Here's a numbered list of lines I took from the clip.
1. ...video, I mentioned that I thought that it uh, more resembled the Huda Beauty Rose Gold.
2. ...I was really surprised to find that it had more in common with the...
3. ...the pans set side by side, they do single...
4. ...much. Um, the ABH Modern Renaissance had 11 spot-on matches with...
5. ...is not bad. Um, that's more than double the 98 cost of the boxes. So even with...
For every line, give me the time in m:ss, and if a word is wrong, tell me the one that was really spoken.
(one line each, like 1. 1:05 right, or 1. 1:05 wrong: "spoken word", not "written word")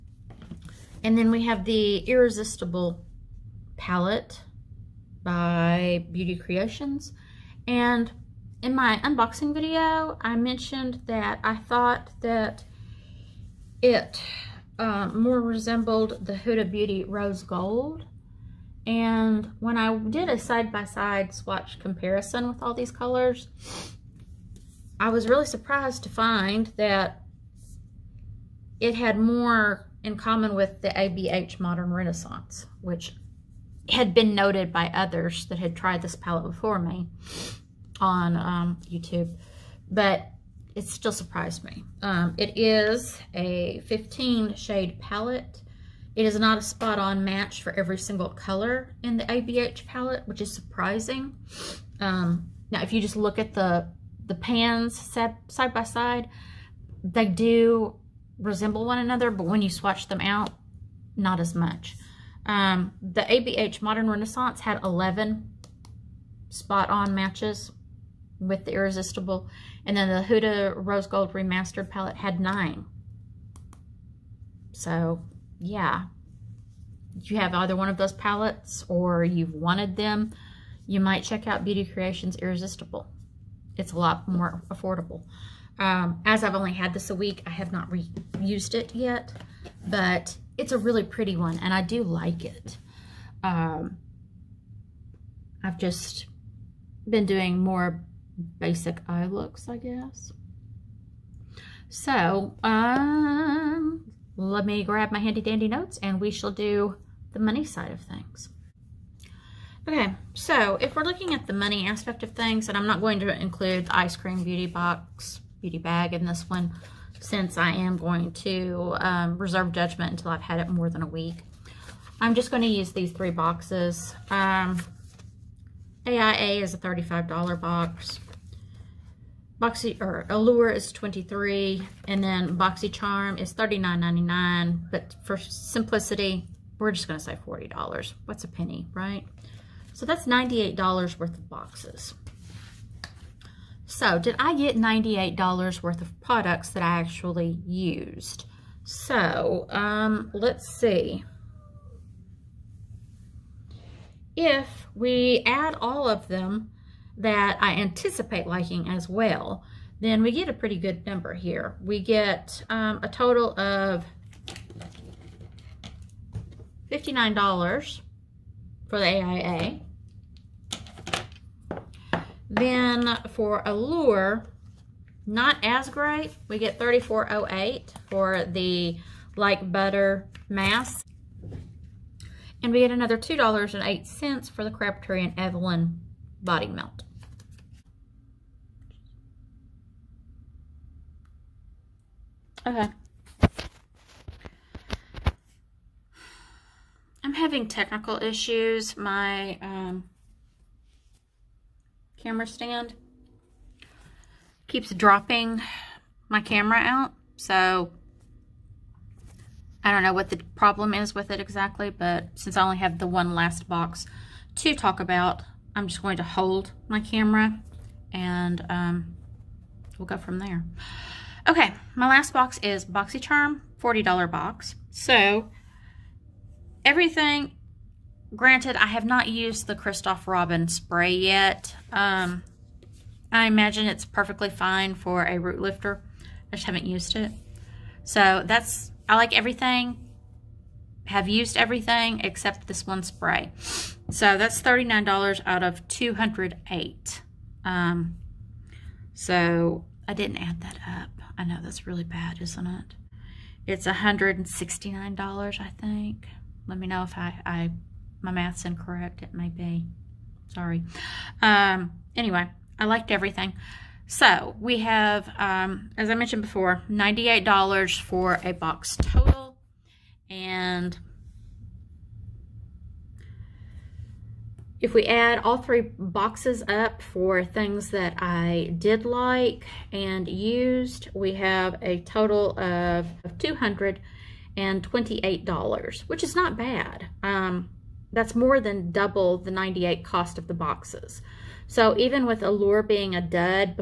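1. 0:09 right
2. 0:25 right
3. 0:54 wrong: "resemble", not "single"
4. 1:01 right
5. 4:46 right.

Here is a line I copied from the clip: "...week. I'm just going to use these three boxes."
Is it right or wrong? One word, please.
right.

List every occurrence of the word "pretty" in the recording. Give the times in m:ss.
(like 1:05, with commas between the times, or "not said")
1:31, 2:40.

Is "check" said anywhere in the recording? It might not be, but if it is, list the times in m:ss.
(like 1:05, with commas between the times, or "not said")
1:21.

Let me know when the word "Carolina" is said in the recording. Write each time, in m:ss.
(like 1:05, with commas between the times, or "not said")
not said.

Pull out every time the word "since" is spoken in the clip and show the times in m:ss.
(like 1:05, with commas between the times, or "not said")
1:57, 3:32.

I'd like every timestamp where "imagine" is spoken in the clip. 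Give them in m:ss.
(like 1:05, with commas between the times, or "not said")
3:53.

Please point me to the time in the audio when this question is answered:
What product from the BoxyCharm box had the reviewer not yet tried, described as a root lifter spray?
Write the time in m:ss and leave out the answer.
3:49.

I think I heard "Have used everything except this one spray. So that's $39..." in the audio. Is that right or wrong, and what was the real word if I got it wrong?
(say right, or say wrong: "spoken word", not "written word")
right.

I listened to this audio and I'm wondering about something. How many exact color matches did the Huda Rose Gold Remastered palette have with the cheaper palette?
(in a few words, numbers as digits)
9.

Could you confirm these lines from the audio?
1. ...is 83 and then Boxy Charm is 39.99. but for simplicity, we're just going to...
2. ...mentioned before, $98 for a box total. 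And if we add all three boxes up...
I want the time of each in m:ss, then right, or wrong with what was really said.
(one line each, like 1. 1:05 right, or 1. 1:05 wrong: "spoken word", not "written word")
1. 2:10 wrong: "23", not "83"
2. 4:26 right.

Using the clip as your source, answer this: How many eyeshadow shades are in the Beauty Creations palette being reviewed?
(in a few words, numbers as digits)
15.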